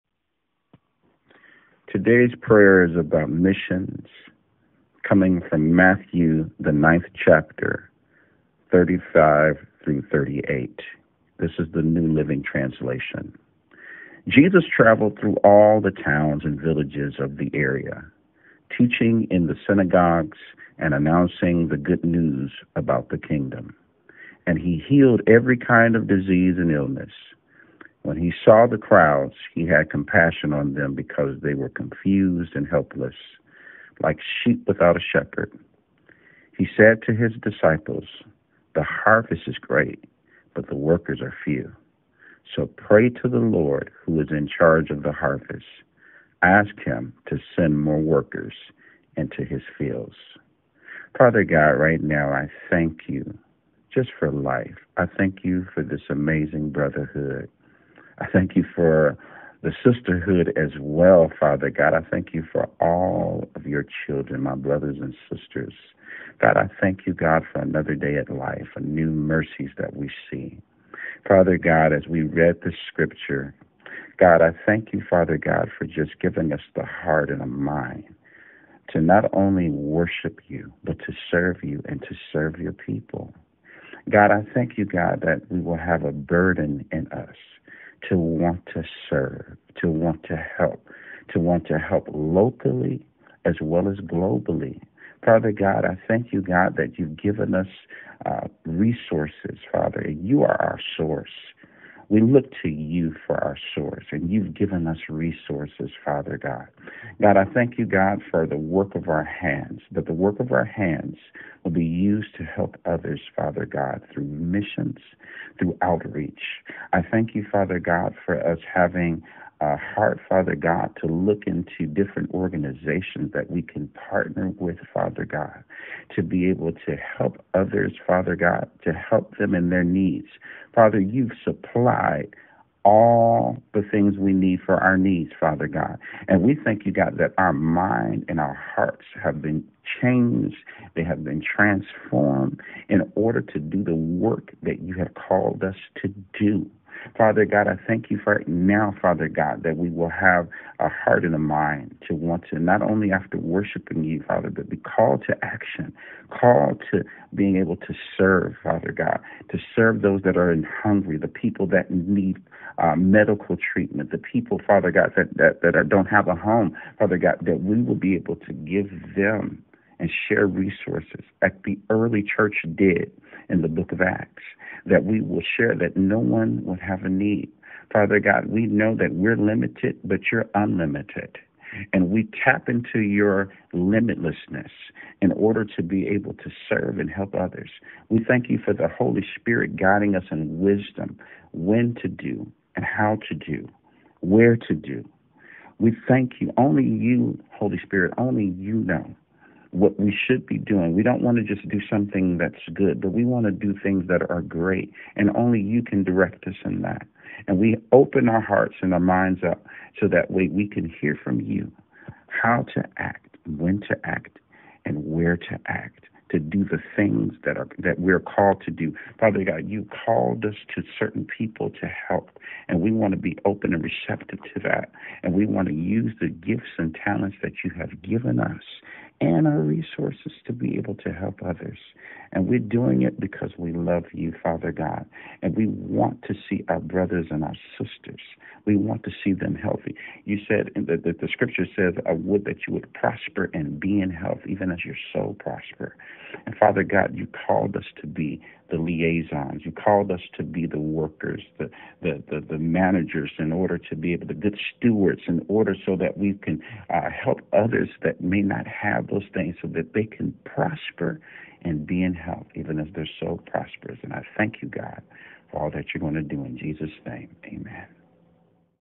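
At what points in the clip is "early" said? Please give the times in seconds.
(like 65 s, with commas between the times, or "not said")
171 s.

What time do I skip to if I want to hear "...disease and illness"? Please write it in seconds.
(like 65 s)
26 s.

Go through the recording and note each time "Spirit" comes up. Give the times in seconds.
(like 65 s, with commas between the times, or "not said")
189 s, 197 s.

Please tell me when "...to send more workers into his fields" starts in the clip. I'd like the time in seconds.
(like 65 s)
47 s.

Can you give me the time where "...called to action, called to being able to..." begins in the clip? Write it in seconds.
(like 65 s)
154 s.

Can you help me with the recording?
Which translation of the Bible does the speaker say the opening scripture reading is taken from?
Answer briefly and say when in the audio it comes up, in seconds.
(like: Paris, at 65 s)
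New Living Translation, at 11 s.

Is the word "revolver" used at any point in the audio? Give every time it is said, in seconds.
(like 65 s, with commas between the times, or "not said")
not said.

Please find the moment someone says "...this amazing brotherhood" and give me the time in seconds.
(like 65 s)
55 s.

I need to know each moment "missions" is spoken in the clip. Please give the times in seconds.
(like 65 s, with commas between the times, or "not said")
3 s, 114 s.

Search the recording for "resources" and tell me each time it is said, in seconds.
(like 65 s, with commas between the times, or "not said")
98 s, 105 s, 170 s, 229 s.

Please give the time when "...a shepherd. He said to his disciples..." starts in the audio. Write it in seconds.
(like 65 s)
34 s.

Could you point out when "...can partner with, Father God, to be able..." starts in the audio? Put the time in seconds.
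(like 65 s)
123 s.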